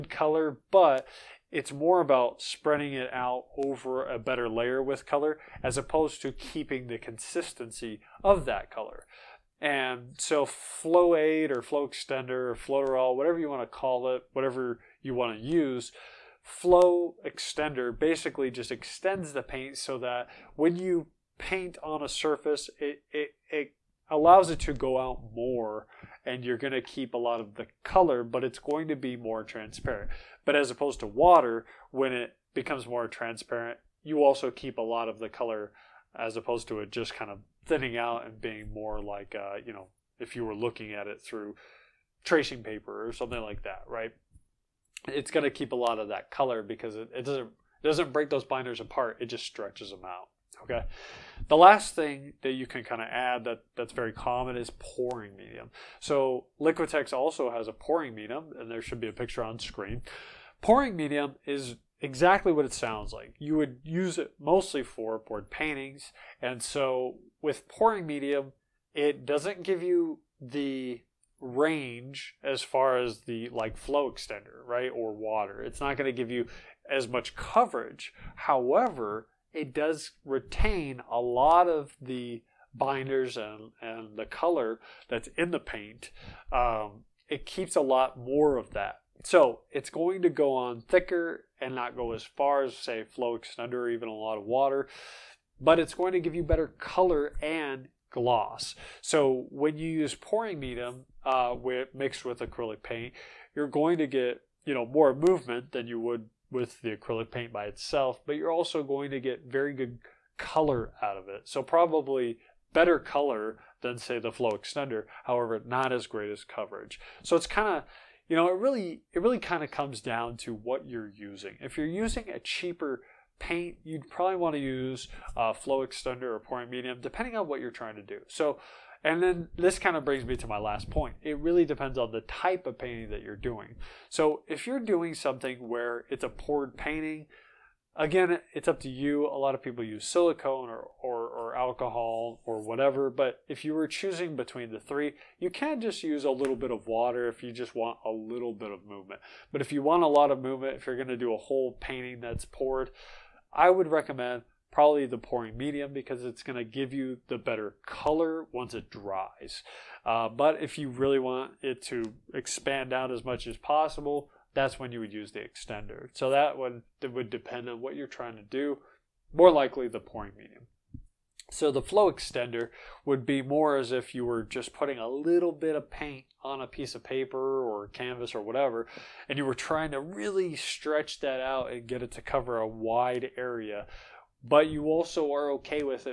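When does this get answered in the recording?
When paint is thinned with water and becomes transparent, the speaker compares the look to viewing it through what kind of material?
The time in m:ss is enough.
0:42.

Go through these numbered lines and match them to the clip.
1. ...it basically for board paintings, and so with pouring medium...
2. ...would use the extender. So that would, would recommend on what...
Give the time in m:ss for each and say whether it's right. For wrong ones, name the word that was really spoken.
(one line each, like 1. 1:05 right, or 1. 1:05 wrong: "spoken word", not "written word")
1. 1:04 wrong: "mostly", not "basically"
2. 2:44 wrong: "depend", not "recommend".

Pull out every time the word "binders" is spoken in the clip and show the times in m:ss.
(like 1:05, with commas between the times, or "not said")
0:48, 1:22.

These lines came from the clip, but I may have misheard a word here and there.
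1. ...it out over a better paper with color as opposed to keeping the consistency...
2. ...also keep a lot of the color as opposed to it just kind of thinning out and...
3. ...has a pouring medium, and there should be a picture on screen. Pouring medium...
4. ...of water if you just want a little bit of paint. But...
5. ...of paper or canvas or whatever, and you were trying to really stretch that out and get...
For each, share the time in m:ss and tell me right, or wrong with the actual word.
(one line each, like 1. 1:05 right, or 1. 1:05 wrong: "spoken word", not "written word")
1. 0:02 wrong: "layer", not "paper"
2. 0:34 right
3. 0:57 right
4. 2:26 wrong: "movement", not "paint"
5. 2:56 right.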